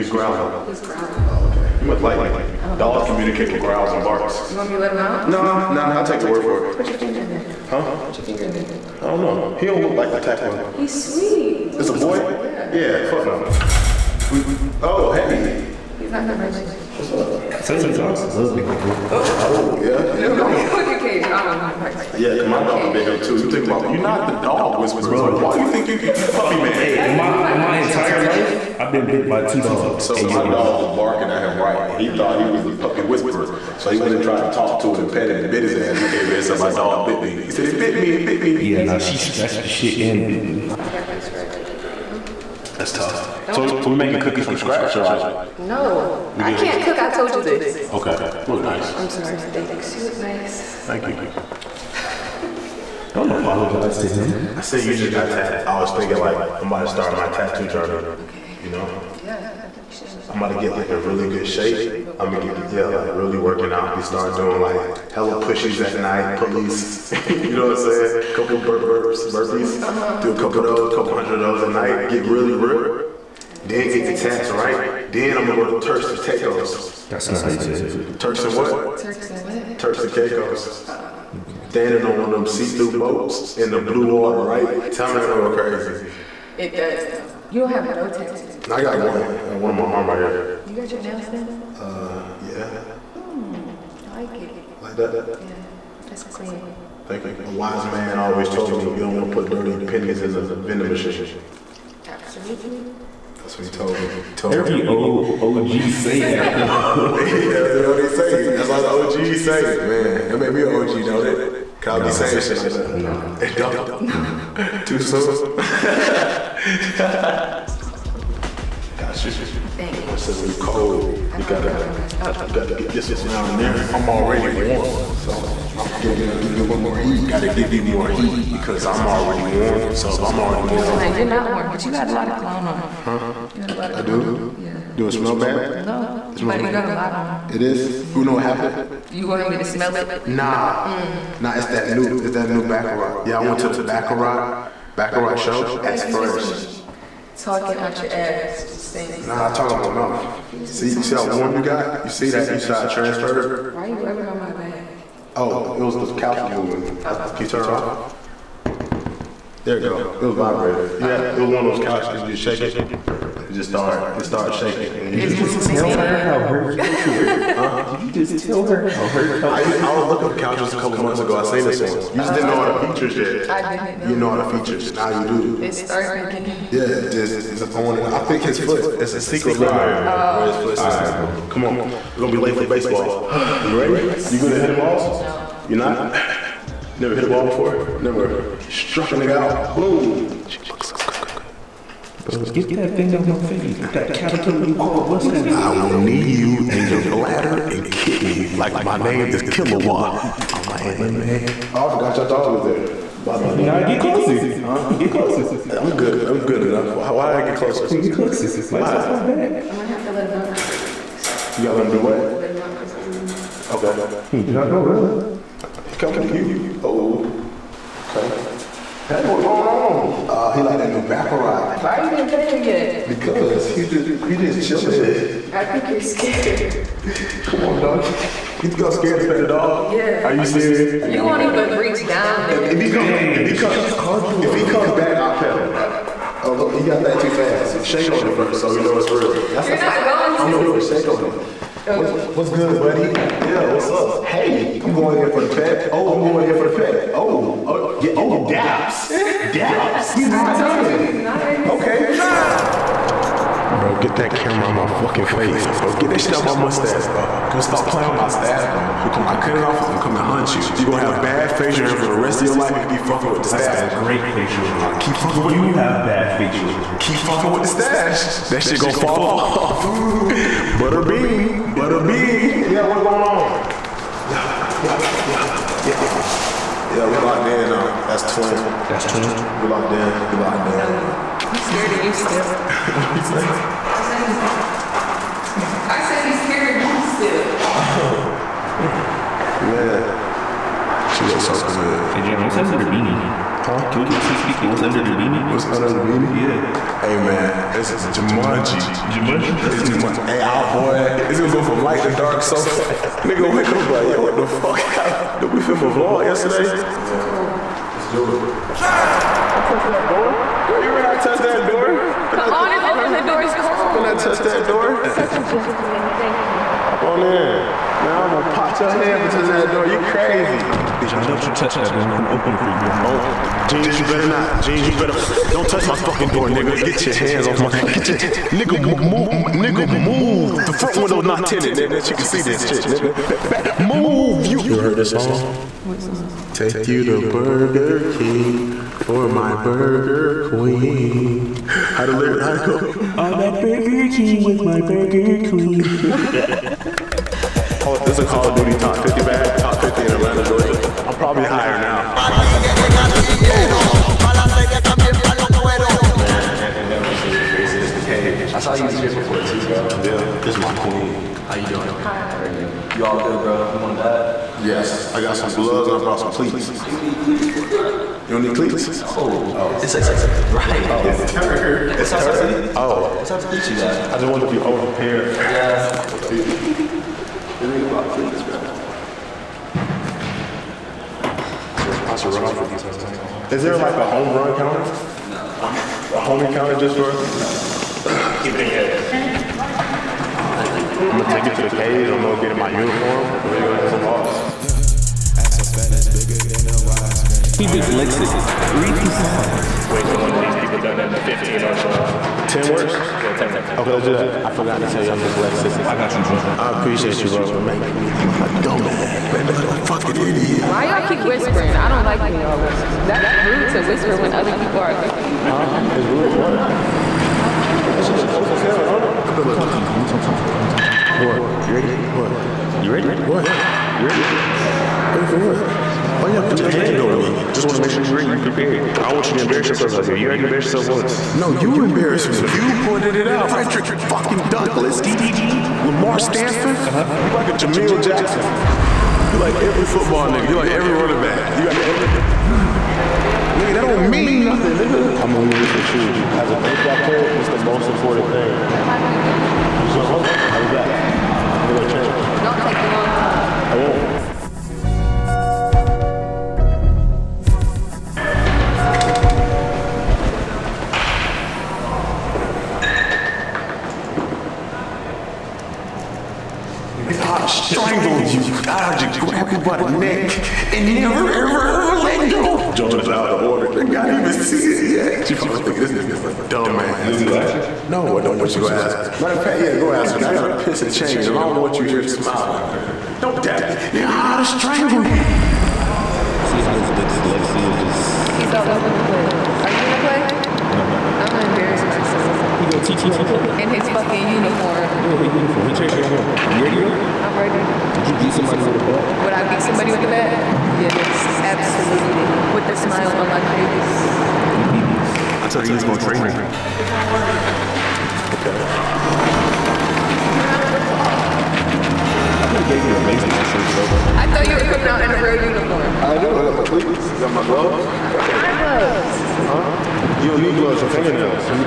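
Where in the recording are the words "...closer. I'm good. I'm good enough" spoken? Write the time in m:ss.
3:25.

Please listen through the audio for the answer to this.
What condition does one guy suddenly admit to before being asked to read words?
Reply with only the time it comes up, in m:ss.
6:45.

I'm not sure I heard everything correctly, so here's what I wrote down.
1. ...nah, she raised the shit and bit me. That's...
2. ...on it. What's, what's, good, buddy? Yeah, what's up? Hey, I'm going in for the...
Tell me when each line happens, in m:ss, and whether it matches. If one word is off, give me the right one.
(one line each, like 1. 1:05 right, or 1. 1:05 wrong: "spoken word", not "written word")
1. 0:38 wrong: "scratched", not "raised"
2. 4:01 right.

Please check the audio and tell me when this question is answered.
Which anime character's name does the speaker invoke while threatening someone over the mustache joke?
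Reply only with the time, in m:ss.
3:19.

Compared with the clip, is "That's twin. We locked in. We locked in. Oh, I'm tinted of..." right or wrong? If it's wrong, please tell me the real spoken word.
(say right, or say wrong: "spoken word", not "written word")
wrong: "scared", not "tinted".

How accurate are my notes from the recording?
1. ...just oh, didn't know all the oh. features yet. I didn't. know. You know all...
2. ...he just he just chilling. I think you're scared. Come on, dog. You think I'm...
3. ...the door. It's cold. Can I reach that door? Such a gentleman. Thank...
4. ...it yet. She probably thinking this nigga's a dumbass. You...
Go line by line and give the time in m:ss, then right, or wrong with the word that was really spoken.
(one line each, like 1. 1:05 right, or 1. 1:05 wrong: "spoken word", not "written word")
1. 2:52 right
2. 3:43 right
3. 5:13 wrong: "touch", not "reach"
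4. 7:54 right.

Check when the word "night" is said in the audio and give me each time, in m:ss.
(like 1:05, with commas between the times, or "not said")
1:05, 1:11.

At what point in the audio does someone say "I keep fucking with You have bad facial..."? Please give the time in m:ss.
4:24.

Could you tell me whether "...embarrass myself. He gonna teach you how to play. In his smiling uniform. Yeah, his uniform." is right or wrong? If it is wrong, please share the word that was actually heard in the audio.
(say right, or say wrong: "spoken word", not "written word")
wrong: "fucking", not "smiling".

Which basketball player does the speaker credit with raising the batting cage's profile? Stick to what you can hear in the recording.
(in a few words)
Anthony Edwards.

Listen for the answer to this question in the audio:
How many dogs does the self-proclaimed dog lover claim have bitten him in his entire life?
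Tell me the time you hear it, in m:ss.
0:29.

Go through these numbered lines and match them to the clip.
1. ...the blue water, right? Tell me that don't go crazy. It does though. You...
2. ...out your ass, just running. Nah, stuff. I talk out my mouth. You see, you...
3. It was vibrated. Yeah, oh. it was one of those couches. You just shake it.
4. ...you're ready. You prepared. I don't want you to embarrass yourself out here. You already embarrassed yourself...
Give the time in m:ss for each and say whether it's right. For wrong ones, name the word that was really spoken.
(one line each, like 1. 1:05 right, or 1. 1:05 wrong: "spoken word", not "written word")
1. 1:23 right
2. 2:27 wrong: "saying", not "running"
3. 2:40 right
4. 7:08 right.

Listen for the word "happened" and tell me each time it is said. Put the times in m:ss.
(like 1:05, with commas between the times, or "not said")
2:18, 5:04.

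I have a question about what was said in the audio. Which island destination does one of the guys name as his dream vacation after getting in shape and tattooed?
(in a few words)
Turks and Caicos.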